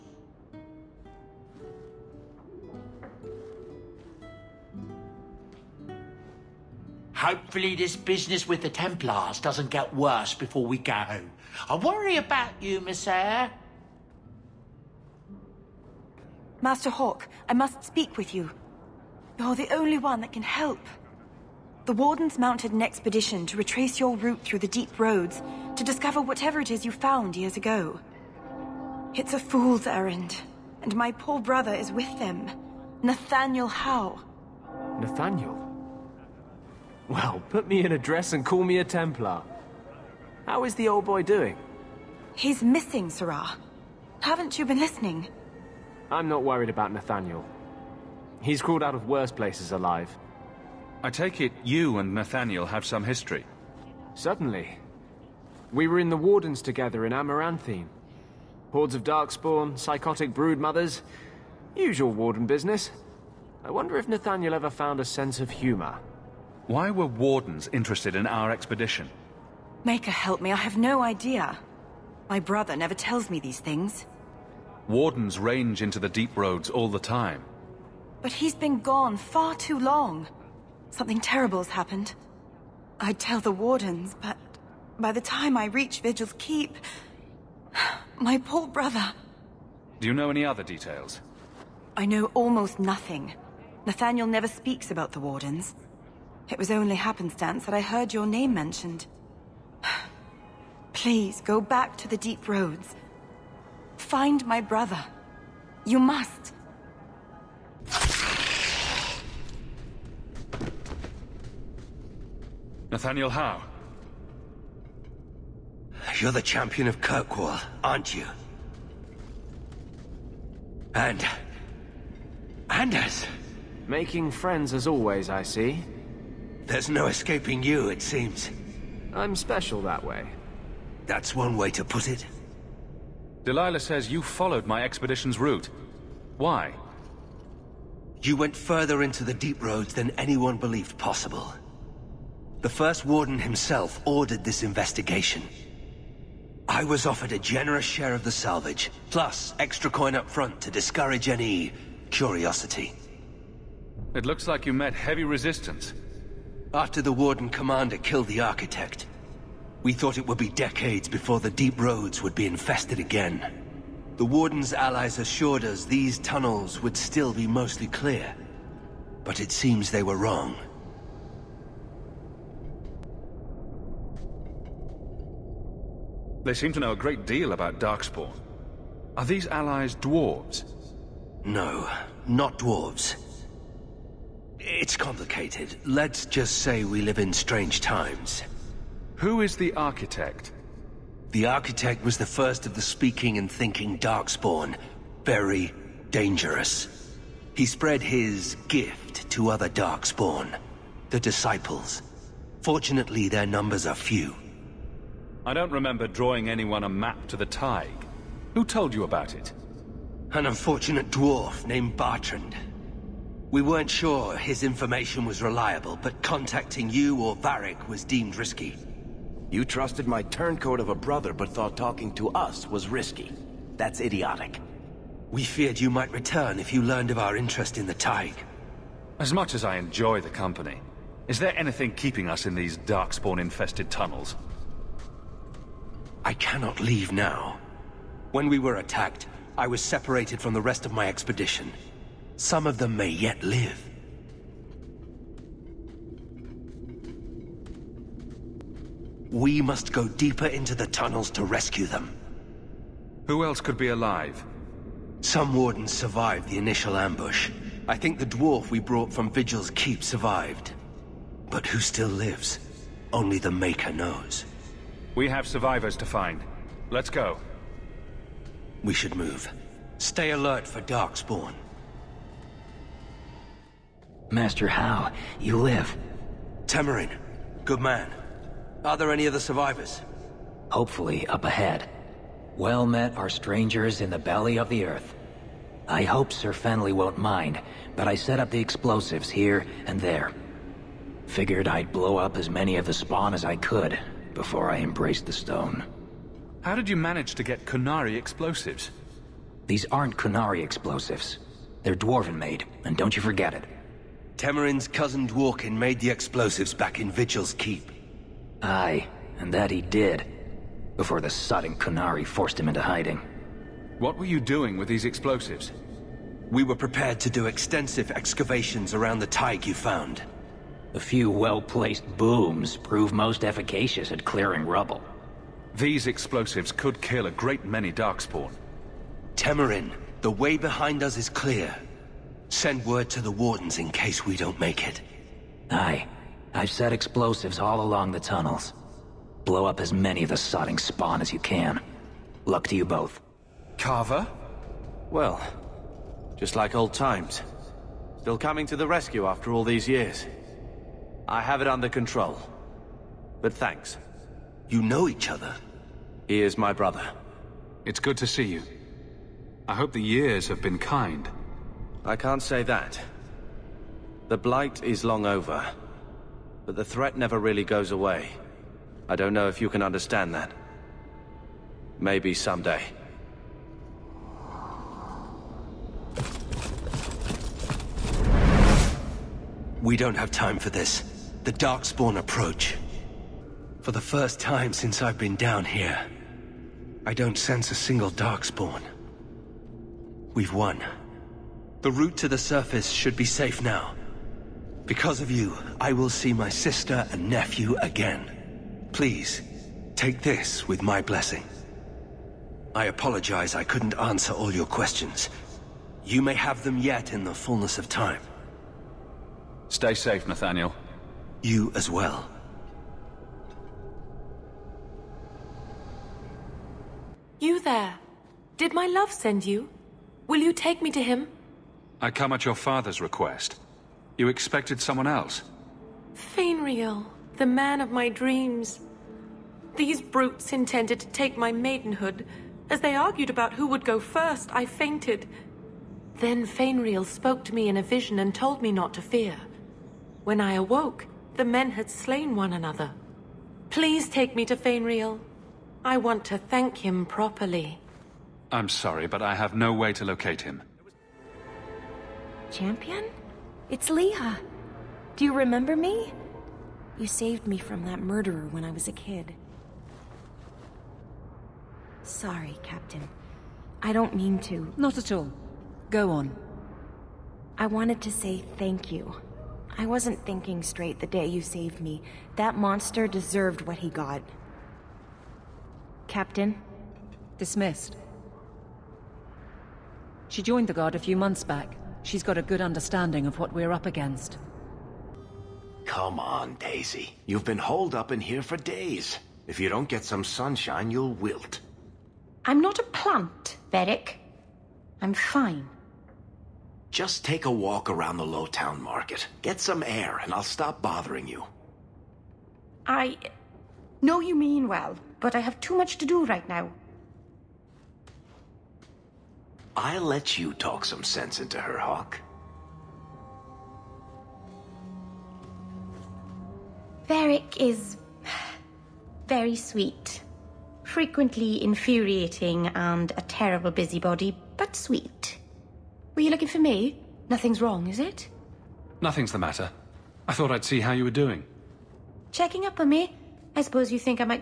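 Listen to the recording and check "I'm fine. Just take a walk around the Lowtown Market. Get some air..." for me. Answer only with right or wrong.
right.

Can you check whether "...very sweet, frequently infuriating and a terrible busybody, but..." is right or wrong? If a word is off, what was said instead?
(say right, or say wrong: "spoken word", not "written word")
right.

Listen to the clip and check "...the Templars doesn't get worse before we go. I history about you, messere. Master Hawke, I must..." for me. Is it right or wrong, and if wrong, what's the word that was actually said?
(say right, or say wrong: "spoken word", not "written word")
wrong: "worry", not "history".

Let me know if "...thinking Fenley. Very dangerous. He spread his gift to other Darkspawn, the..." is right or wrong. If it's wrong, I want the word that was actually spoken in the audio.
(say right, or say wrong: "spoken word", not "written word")
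wrong: "Darkspawn", not "Fenley".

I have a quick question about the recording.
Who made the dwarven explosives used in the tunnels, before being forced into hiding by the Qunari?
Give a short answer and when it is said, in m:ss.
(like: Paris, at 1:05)
Dworkin, at 5:05.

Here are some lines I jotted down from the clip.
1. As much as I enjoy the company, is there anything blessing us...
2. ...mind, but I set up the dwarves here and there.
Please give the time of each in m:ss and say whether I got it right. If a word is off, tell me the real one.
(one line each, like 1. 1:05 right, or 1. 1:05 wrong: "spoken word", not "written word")
1. 3:49 wrong: "keeping", not "blessing"
2. 4:47 wrong: "explosives", not "dwarves".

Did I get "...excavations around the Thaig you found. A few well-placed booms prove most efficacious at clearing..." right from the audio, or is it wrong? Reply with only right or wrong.
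right.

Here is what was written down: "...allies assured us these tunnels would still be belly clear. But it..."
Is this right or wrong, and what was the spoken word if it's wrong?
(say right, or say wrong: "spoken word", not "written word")
wrong: "mostly", not "belly".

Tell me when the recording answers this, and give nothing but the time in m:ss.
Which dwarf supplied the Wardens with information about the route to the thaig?
3:31.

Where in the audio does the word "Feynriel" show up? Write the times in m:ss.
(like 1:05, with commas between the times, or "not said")
7:06, 7:16, 7:24.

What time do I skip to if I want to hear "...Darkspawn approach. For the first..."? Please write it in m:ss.
6:21.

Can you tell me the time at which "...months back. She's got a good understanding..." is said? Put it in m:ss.
8:01.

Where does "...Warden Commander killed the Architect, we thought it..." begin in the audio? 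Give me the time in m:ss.
2:37.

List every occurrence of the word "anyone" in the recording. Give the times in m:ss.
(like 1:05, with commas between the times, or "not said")
2:20, 3:26.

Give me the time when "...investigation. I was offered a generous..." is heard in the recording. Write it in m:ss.
2:24.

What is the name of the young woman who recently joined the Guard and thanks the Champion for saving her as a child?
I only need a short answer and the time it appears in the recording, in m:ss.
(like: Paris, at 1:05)
Leah, at 7:33.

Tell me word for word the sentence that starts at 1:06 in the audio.
Why were wardens interested in our expedition?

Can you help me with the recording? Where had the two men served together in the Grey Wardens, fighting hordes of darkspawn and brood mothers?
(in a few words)
Amaranthine.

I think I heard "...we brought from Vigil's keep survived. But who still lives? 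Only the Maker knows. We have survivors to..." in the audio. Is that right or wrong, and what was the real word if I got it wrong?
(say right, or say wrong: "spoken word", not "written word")
right.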